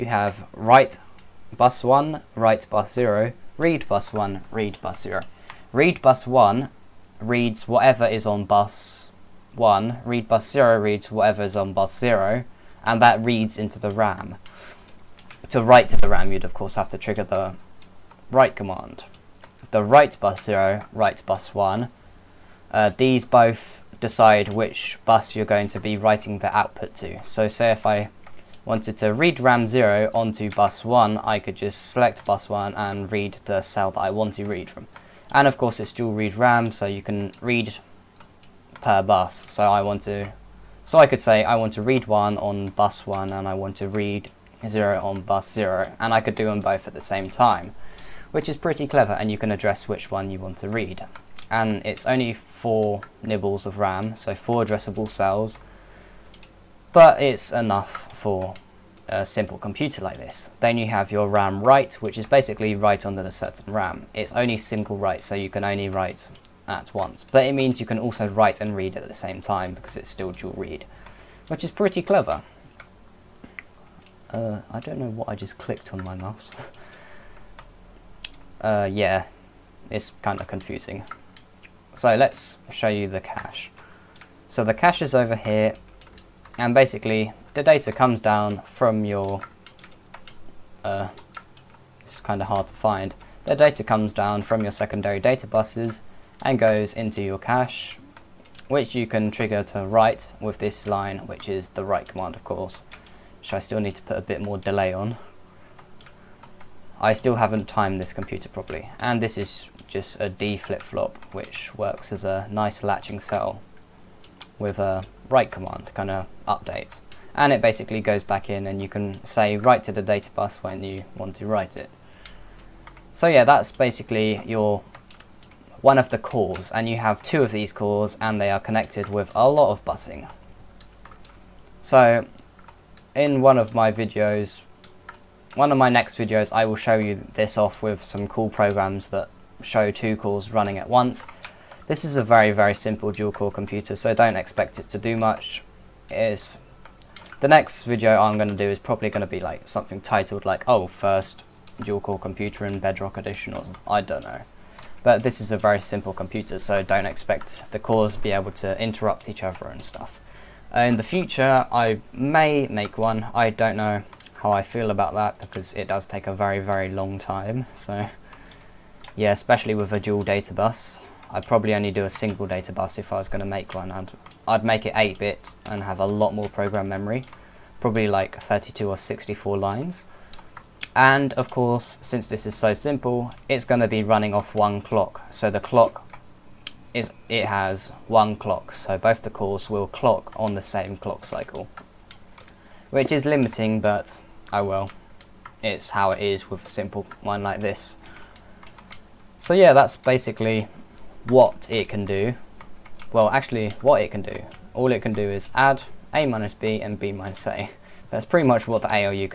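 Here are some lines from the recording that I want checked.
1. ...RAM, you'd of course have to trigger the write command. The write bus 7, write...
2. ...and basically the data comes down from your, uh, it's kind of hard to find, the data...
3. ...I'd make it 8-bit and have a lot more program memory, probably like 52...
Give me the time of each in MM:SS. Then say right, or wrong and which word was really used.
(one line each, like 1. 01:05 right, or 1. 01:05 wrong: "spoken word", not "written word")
1. 00:16 wrong: "0", not "7"
2. 01:26 right
3. 02:54 wrong: "32", not "52".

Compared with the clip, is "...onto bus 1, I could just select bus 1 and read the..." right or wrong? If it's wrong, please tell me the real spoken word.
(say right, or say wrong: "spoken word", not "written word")
right.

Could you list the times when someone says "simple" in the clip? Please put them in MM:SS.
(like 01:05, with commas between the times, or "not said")
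00:59, 02:22, 02:35, 03:02, 03:16.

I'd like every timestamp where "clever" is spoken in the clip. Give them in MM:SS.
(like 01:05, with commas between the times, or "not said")
00:48, 01:11.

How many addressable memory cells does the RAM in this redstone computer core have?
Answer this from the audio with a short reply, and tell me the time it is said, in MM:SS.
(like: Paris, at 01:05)
4, at 00:54.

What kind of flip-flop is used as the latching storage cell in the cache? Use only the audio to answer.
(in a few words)
D flip-flop.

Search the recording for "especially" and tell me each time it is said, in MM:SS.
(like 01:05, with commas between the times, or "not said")
02:49.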